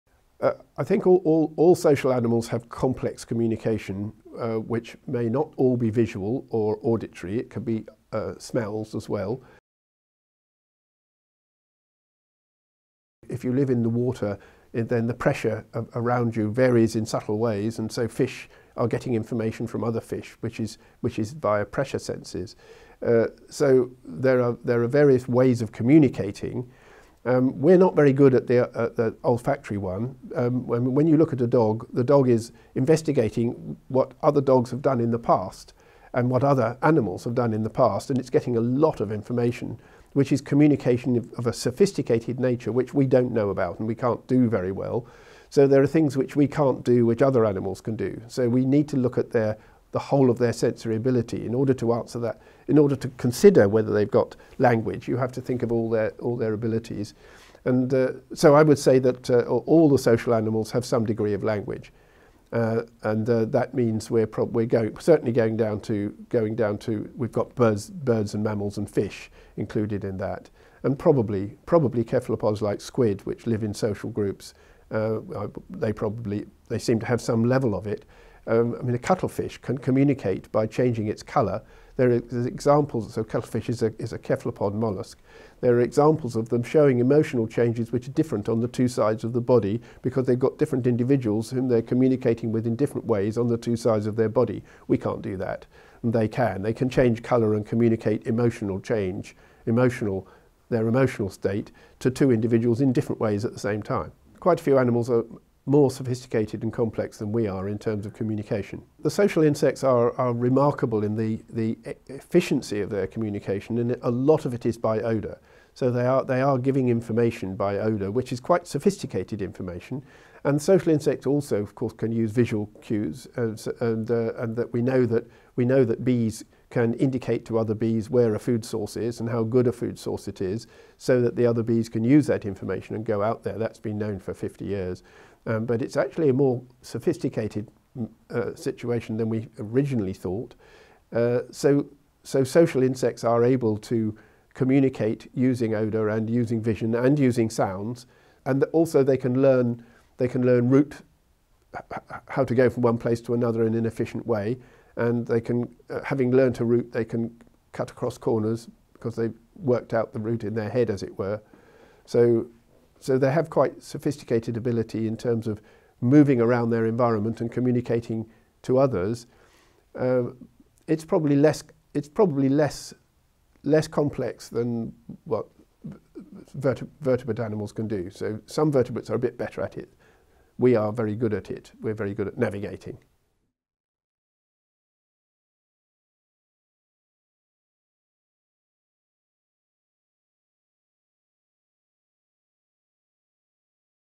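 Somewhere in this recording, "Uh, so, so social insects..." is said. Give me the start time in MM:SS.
02:21.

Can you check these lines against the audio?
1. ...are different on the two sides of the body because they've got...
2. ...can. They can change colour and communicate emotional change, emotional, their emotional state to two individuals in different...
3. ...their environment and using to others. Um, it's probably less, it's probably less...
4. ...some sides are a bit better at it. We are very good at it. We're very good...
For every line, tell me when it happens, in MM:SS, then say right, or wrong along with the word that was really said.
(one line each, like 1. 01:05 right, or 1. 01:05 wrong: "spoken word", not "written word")
1. 01:28 right
2. 01:36 right
3. 02:46 wrong: "communicating", not "using"
4. 02:58 wrong: "vertebrates", not "sides".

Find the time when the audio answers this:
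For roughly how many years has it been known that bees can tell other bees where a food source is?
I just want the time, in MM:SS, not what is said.
02:14.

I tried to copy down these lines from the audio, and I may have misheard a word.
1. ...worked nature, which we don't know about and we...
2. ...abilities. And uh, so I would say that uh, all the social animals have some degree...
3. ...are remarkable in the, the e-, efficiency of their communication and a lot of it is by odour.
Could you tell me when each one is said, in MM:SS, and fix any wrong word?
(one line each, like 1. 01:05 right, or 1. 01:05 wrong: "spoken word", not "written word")
1. 00:41 wrong: "sophisticated", not "worked"
2. 00:56 right
3. 01:50 right.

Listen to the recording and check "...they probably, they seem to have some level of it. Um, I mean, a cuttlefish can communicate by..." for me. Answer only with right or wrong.
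right.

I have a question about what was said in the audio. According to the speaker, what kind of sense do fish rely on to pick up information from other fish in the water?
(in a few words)
Pressure senses.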